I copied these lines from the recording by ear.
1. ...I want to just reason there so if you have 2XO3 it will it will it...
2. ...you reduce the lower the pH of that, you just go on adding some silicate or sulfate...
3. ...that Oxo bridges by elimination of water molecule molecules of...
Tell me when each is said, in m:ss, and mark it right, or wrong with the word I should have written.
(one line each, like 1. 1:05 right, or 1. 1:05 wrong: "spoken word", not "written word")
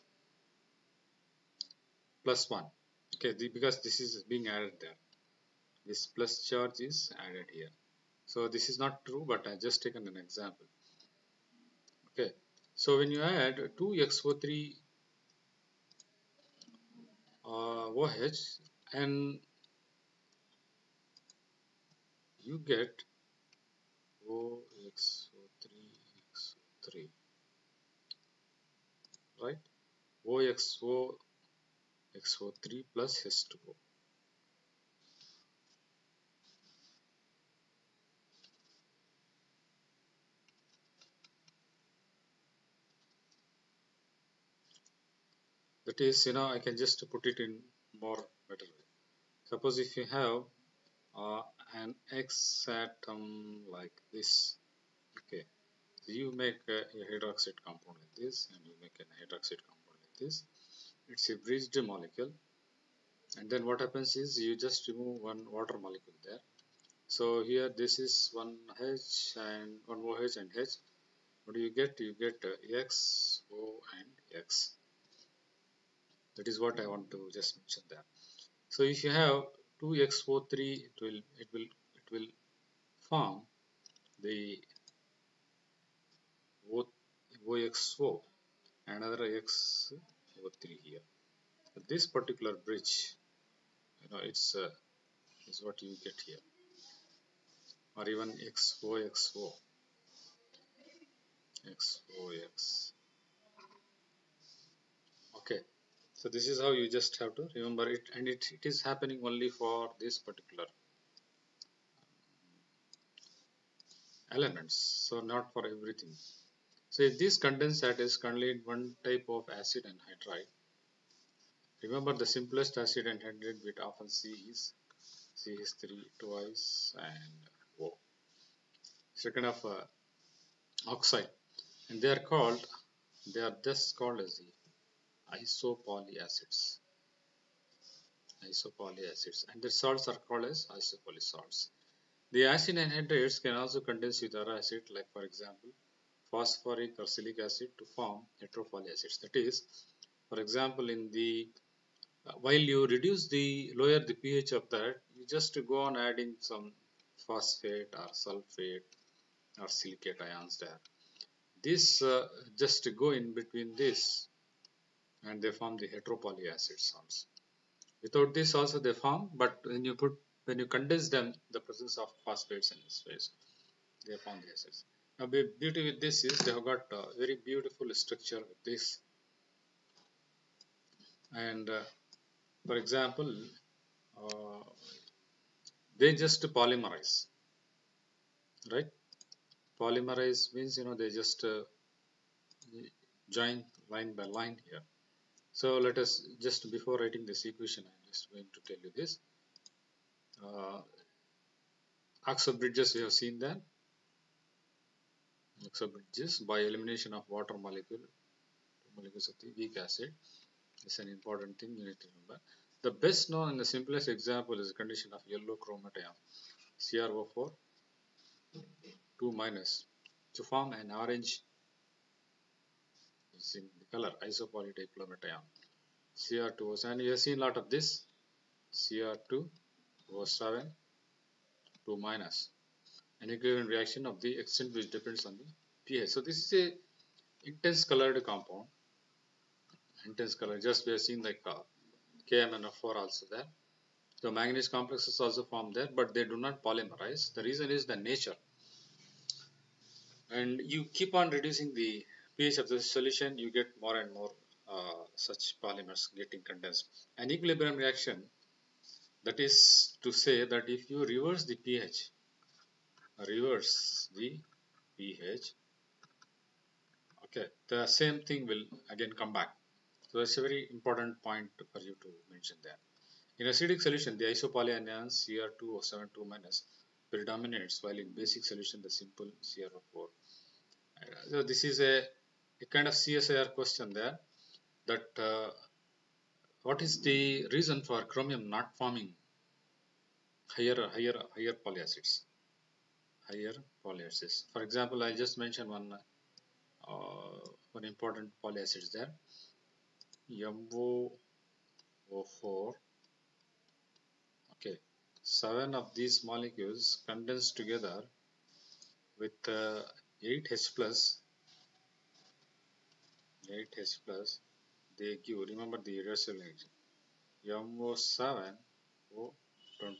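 1. 1:16 wrong: "mention", not "reason"
2. 2:32 wrong: "phosphate", not "silicate"
3. 3:23 right.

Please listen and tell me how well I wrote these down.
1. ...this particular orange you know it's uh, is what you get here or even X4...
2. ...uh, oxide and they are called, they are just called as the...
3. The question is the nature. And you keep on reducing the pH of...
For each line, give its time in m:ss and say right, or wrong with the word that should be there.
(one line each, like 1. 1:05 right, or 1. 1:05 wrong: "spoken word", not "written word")
1. 1:31 wrong: "bridge", not "orange"
2. 2:09 right
3. 4:07 wrong: "reason", not "question".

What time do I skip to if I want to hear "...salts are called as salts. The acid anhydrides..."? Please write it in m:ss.
2:19.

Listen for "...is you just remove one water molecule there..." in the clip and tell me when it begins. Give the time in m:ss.
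1:04.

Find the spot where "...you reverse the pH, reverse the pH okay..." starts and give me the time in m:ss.
4:20.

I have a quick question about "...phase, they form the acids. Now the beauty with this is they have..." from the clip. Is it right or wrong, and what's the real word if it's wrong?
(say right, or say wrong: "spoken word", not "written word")
right.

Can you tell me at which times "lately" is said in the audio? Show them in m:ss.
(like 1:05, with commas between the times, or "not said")
not said.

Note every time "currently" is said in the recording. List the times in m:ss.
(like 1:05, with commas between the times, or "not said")
1:58.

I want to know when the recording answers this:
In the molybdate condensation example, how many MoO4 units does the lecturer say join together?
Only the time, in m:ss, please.
5:05.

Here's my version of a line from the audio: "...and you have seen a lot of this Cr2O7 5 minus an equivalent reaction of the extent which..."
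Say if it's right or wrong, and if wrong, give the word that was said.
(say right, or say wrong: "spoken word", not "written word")
wrong: "2", not "5".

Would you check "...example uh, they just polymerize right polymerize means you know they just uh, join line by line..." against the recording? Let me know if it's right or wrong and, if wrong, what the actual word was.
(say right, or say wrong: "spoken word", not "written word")
right.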